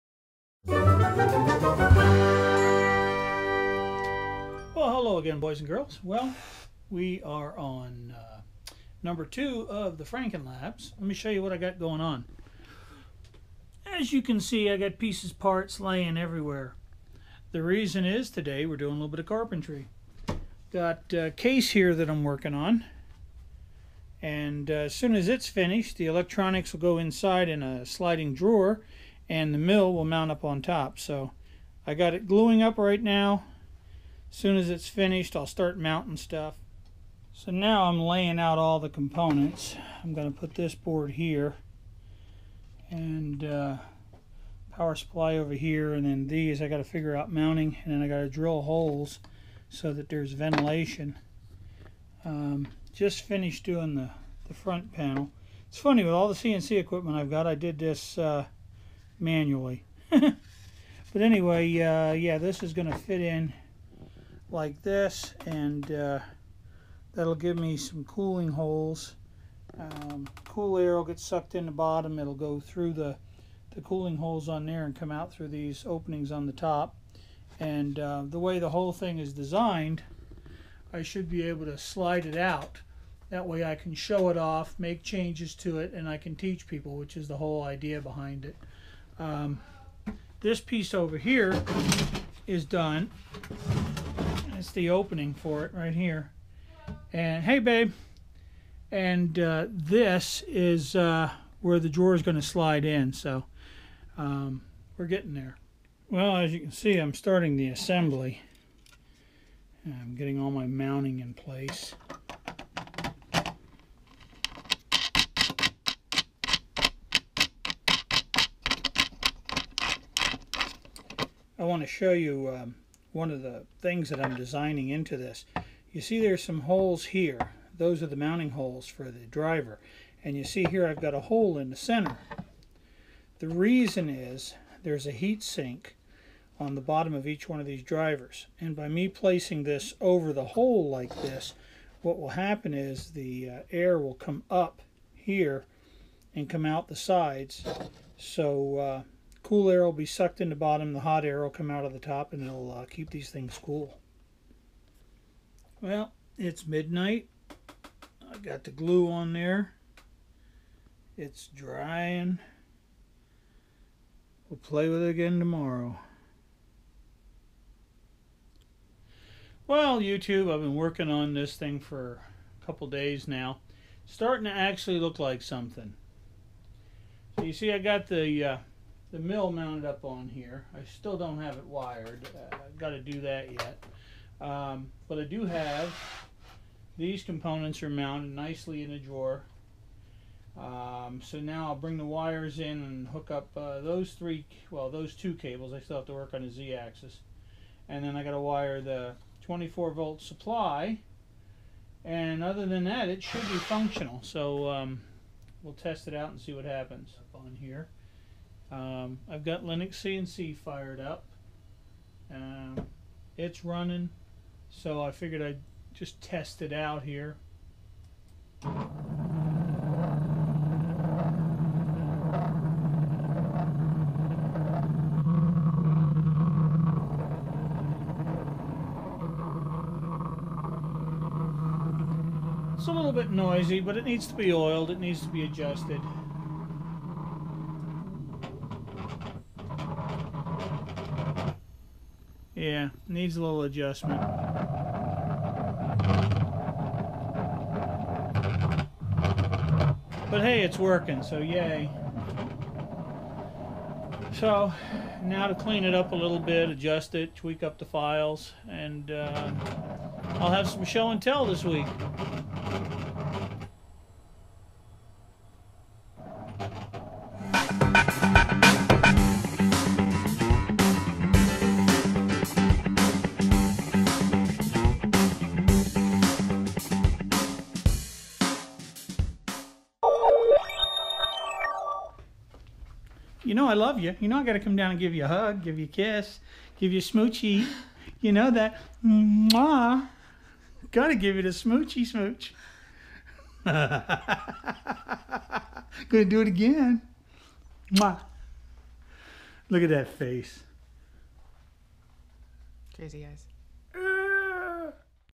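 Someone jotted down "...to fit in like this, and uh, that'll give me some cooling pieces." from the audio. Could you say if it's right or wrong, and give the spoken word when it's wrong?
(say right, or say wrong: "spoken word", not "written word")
wrong: "holes", not "pieces".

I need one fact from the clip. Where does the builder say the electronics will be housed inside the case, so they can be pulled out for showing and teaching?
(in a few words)
sliding drawer.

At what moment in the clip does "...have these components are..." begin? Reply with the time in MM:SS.
03:05.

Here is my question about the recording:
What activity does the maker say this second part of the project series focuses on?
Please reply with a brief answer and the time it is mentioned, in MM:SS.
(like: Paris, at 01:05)
carpentry, at 00:19.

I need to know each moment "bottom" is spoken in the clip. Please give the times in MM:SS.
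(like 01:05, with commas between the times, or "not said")
01:11, 02:16, 02:30.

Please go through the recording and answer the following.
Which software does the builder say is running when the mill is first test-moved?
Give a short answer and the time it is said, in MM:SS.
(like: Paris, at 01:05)
LinuxCNC, at 03:29.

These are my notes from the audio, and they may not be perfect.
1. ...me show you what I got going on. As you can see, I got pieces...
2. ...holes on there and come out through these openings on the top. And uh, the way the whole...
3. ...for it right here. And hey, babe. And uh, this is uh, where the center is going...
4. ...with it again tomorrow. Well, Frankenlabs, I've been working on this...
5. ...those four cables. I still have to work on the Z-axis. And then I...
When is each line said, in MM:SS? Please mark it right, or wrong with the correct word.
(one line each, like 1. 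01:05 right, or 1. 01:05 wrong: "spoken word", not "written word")
1. 00:11 right
2. 01:14 right
3. 01:35 wrong: "drawer", not "center"
4. 02:44 wrong: "YouTube", not "Frankenlabs"
5. 03:14 wrong: "two", not "four".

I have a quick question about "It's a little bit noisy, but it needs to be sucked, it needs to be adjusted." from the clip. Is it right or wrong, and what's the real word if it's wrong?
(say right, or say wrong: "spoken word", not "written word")
wrong: "oiled", not "sucked".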